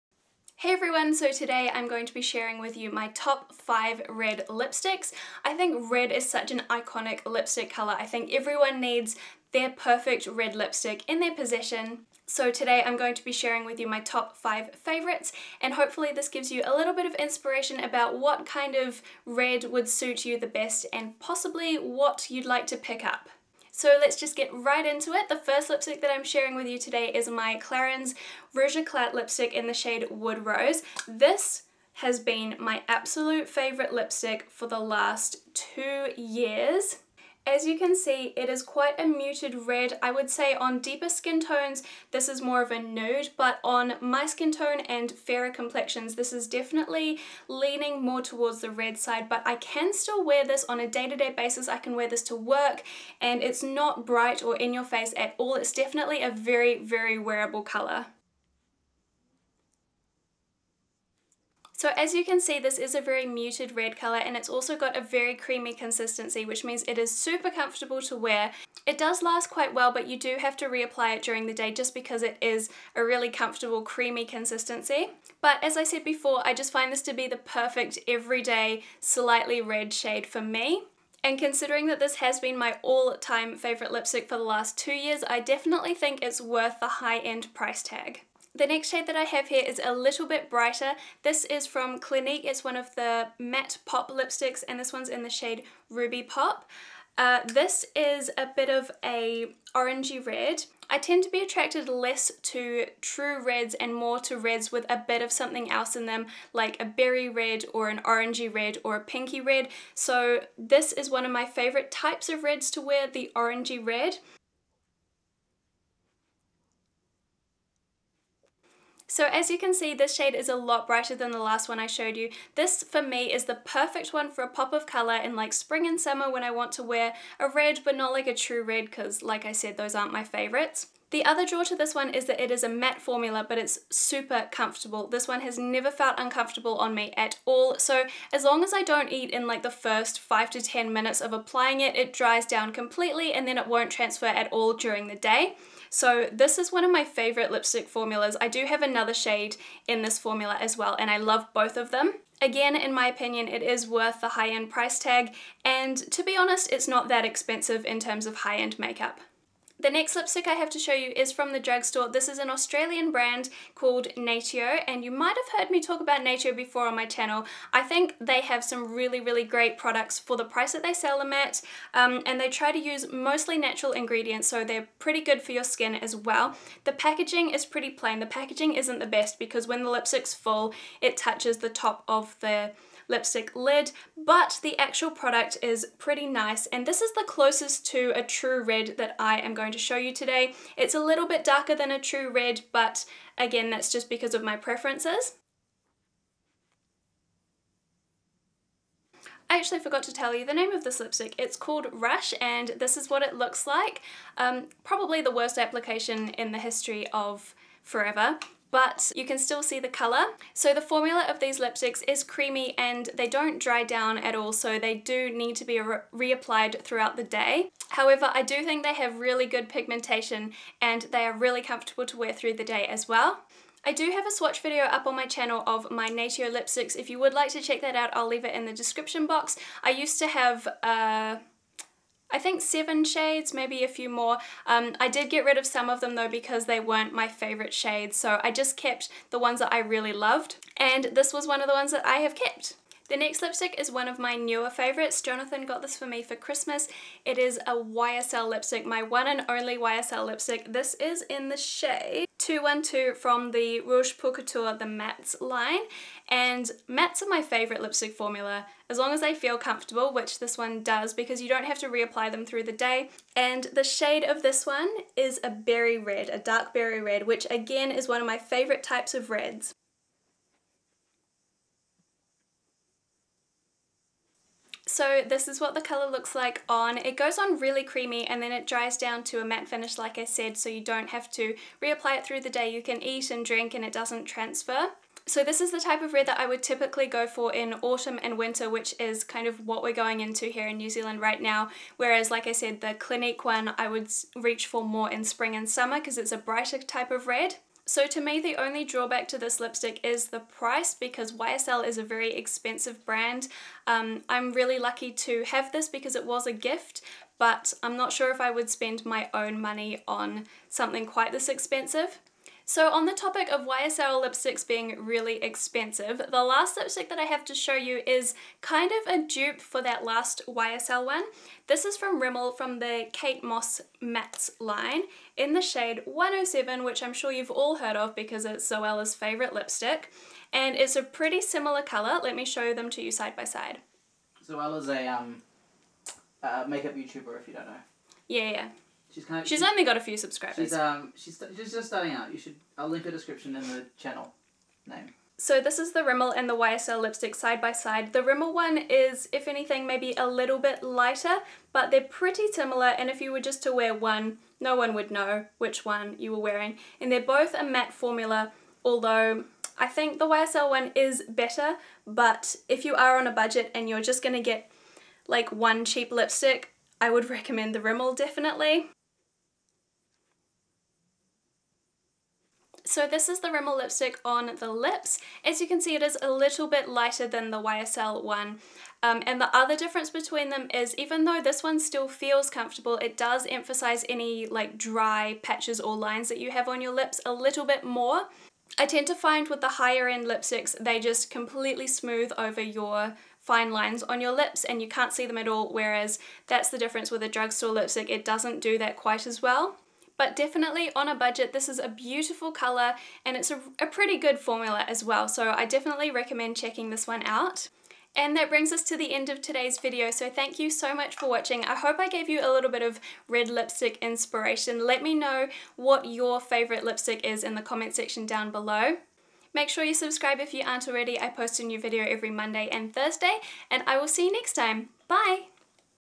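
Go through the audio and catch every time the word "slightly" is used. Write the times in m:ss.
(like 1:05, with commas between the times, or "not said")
1:18.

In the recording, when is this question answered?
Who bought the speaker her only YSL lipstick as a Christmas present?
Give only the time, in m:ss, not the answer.
4:05.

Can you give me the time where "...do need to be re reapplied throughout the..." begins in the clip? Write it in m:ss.
3:34.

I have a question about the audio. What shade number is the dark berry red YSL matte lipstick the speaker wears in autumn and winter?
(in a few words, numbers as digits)
212.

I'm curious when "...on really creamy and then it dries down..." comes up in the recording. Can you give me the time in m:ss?
4:37.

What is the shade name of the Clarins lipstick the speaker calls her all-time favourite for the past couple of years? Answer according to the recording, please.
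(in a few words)
Wood Rose.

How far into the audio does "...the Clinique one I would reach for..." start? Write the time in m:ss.
4:52.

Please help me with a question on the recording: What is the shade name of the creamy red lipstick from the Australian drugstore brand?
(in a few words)
Rush.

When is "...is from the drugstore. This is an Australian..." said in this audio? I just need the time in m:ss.
2:41.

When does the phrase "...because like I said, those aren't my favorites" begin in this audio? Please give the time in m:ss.
2:08.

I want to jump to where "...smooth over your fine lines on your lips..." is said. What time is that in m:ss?
6:31.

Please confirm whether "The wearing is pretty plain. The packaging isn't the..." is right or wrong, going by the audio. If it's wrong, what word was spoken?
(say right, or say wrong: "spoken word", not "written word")
wrong: "packaging", not "wearing".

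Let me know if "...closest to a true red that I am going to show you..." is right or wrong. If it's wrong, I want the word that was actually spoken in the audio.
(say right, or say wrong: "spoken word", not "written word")
right.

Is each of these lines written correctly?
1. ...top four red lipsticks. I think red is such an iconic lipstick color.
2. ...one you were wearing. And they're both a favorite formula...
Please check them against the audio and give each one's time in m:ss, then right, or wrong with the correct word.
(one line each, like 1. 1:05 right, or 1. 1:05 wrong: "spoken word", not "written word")
1. 0:03 wrong: "five", not "four"
2. 5:55 wrong: "matte", not "favorite".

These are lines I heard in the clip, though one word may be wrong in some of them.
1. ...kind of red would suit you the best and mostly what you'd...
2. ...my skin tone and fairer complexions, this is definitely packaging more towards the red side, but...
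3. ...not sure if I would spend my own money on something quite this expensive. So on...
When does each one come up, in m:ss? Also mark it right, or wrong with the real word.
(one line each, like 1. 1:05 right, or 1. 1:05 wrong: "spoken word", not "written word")
1. 0:18 wrong: "possibly", not "mostly"
2. 0:43 wrong: "leaning", not "packaging"
3. 5:07 right.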